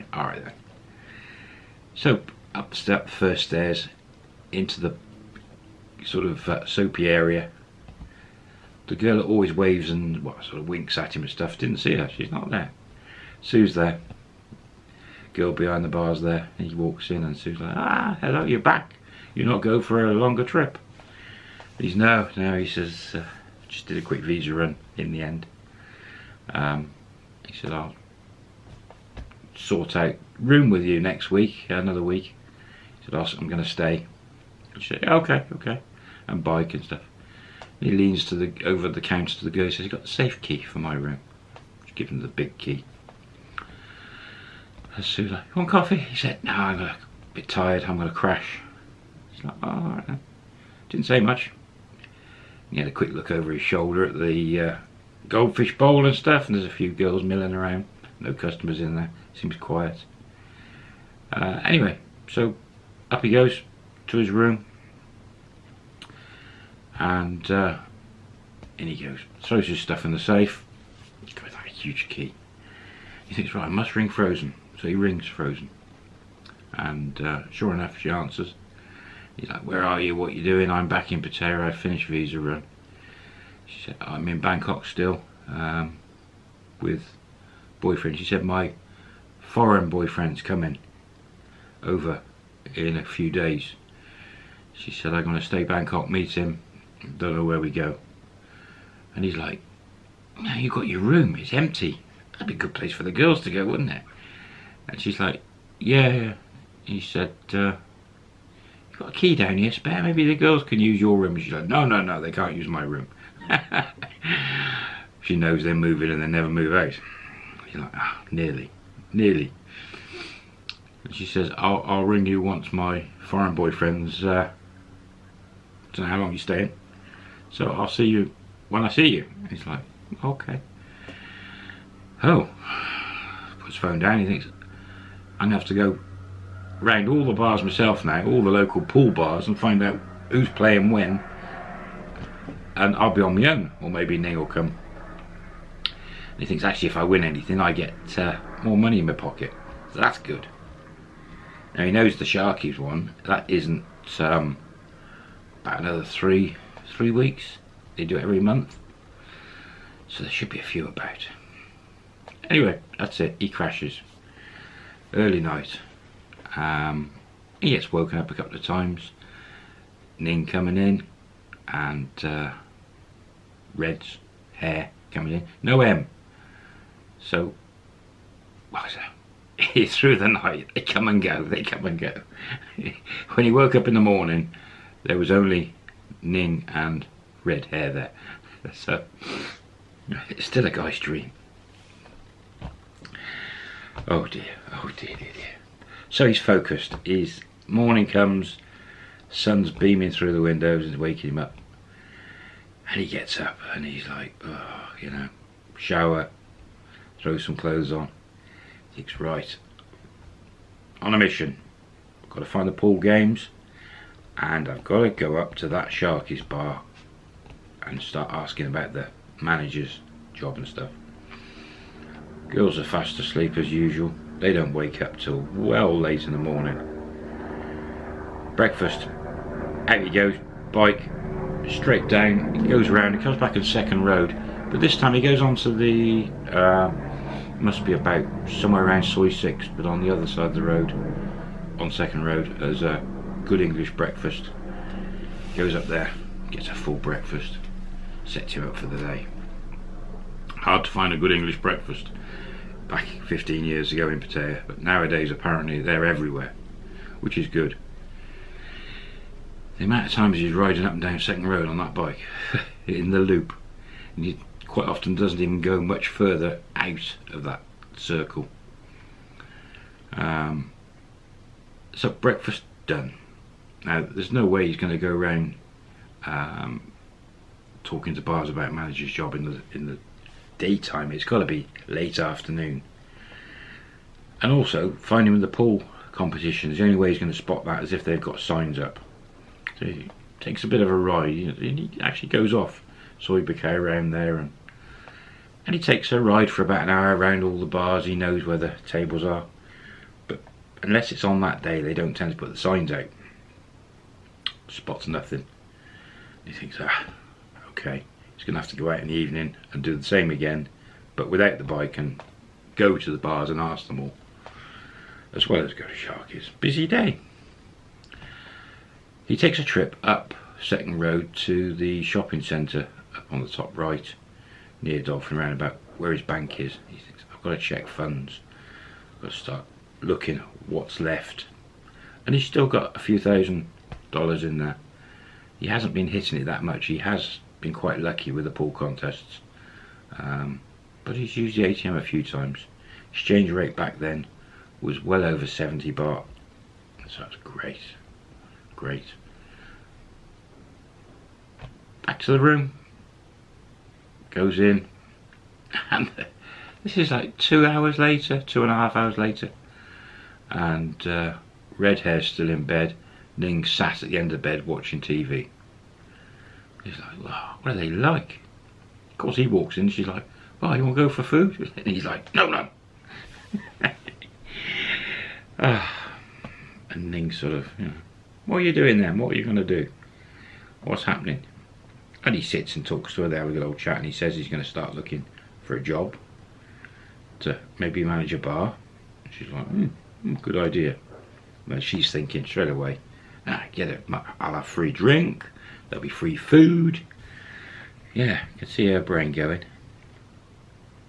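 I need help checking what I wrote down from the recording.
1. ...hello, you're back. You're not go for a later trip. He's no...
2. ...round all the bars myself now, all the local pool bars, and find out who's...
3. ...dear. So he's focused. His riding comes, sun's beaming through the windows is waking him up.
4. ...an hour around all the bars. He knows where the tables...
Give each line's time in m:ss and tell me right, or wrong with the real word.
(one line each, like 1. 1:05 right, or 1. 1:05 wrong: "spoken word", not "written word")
1. 0:18 wrong: "longer", not "later"
2. 2:16 right
3. 3:15 wrong: "morning", not "riding"
4. 4:56 right.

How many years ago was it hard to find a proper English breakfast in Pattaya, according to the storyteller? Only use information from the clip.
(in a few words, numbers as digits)
15.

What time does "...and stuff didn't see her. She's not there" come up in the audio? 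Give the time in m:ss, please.
0:11.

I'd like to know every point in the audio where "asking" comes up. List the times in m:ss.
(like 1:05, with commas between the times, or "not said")
3:38.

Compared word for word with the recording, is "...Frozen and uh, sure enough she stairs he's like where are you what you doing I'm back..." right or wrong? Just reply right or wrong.
wrong.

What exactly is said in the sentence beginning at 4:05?
Goes up there, gets a full breakfast, sets him up for the day.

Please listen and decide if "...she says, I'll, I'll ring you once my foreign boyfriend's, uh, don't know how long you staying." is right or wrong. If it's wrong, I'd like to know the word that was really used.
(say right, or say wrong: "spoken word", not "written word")
right.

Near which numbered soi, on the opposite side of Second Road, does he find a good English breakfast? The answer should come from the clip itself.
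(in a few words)
Soi 6.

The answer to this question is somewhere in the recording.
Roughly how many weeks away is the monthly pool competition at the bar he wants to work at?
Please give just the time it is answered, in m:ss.
2:36.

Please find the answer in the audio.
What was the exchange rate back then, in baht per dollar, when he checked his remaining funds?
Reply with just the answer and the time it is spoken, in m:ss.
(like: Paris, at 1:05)
over 70 baht, at 5:45.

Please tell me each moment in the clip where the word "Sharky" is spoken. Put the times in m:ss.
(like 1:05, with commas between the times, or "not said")
2:32, 3:35, 5:15.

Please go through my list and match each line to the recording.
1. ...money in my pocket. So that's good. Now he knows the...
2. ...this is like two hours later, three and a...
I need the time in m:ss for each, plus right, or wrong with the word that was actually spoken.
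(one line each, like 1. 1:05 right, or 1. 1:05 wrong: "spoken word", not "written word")
1. 2:28 right
2. 5:56 wrong: "two", not "three".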